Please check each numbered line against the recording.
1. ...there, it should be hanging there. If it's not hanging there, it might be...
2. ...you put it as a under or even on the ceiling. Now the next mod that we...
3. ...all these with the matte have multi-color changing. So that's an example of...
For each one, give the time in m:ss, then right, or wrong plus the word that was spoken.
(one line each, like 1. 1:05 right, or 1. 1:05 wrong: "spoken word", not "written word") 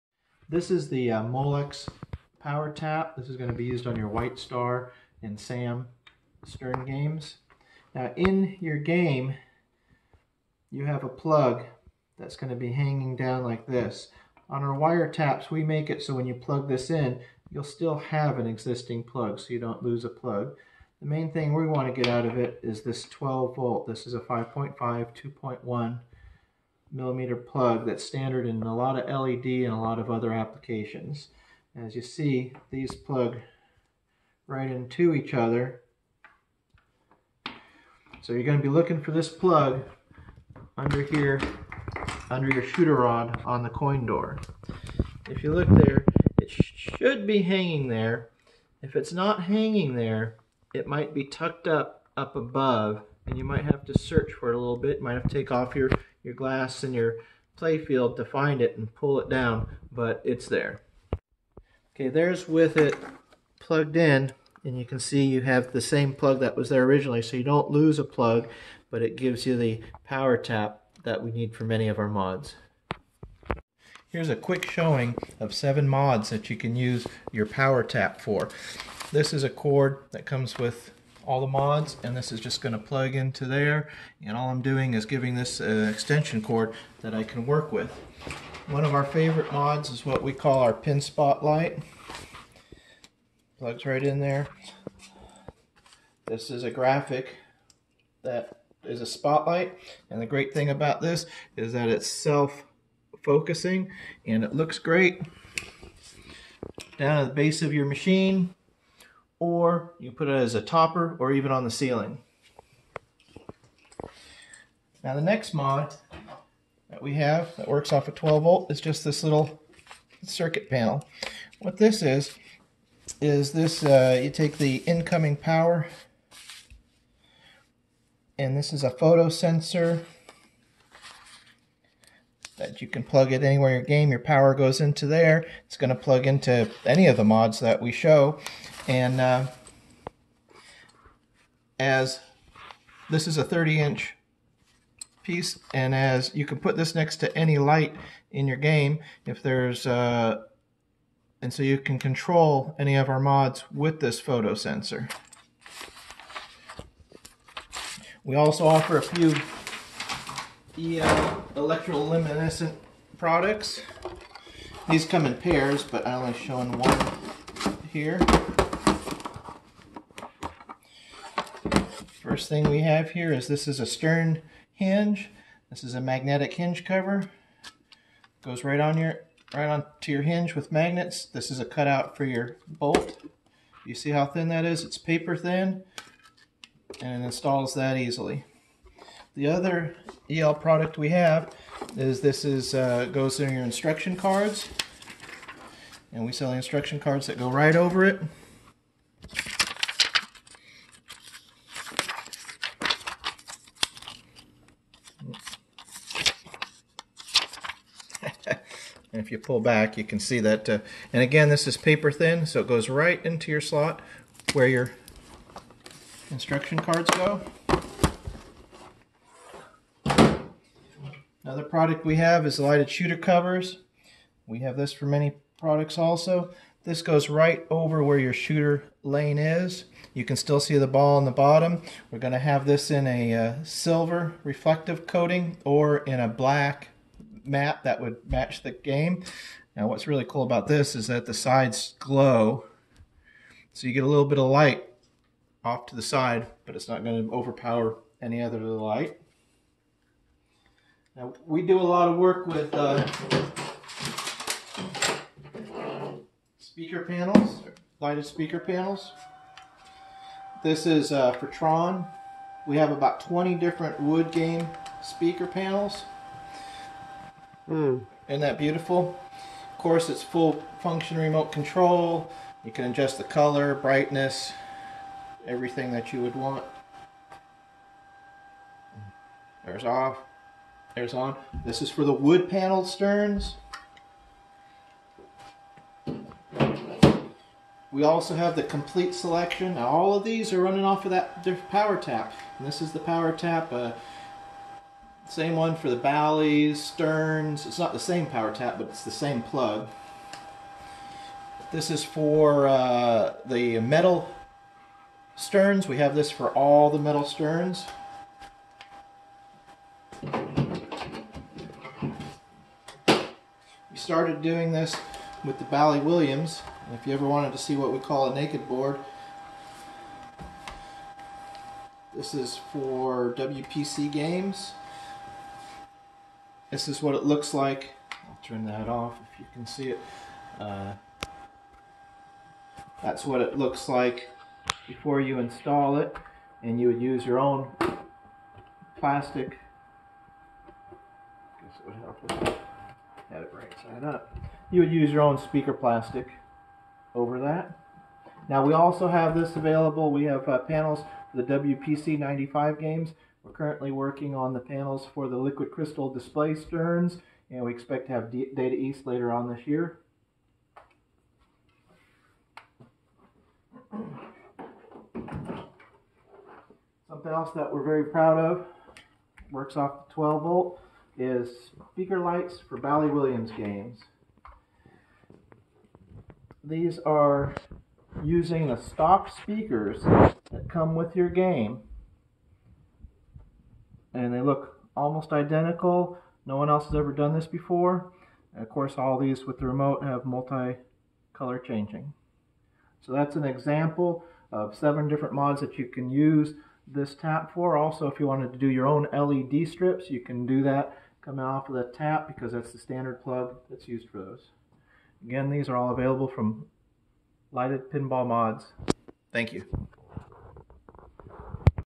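1. 0:45 right
2. 1:49 wrong: "topper", not "under"
3. 6:28 wrong: "remote", not "matte".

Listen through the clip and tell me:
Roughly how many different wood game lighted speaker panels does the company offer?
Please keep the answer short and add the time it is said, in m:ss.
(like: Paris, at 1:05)
20, at 4:23.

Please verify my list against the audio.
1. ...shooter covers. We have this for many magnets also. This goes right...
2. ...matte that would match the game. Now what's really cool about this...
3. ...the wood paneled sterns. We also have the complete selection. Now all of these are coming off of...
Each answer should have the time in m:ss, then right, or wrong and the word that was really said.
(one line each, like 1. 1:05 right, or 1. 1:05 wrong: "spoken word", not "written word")
1. 3:42 wrong: "products", not "magnets"
2. 3:57 right
3. 4:42 wrong: "running", not "coming".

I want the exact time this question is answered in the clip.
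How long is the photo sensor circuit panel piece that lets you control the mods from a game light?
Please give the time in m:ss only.
2:23.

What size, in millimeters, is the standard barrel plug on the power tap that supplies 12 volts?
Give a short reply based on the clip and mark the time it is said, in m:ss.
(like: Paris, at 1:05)
5.5, 2.1 millimeter, at 0:24.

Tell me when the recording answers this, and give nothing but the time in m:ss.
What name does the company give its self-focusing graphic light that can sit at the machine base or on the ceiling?
1:30.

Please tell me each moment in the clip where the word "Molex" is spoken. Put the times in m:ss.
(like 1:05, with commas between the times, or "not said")
0:01.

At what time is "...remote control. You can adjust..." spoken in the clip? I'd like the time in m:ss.
4:31.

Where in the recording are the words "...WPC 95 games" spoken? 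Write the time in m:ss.
5:51.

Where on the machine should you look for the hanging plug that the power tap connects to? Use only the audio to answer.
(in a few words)
under your shooter rod.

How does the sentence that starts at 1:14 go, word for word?
Here's a quick showing of seven mods that you can use your power tap for.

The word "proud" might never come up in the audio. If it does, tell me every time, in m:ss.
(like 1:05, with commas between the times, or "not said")
6:08.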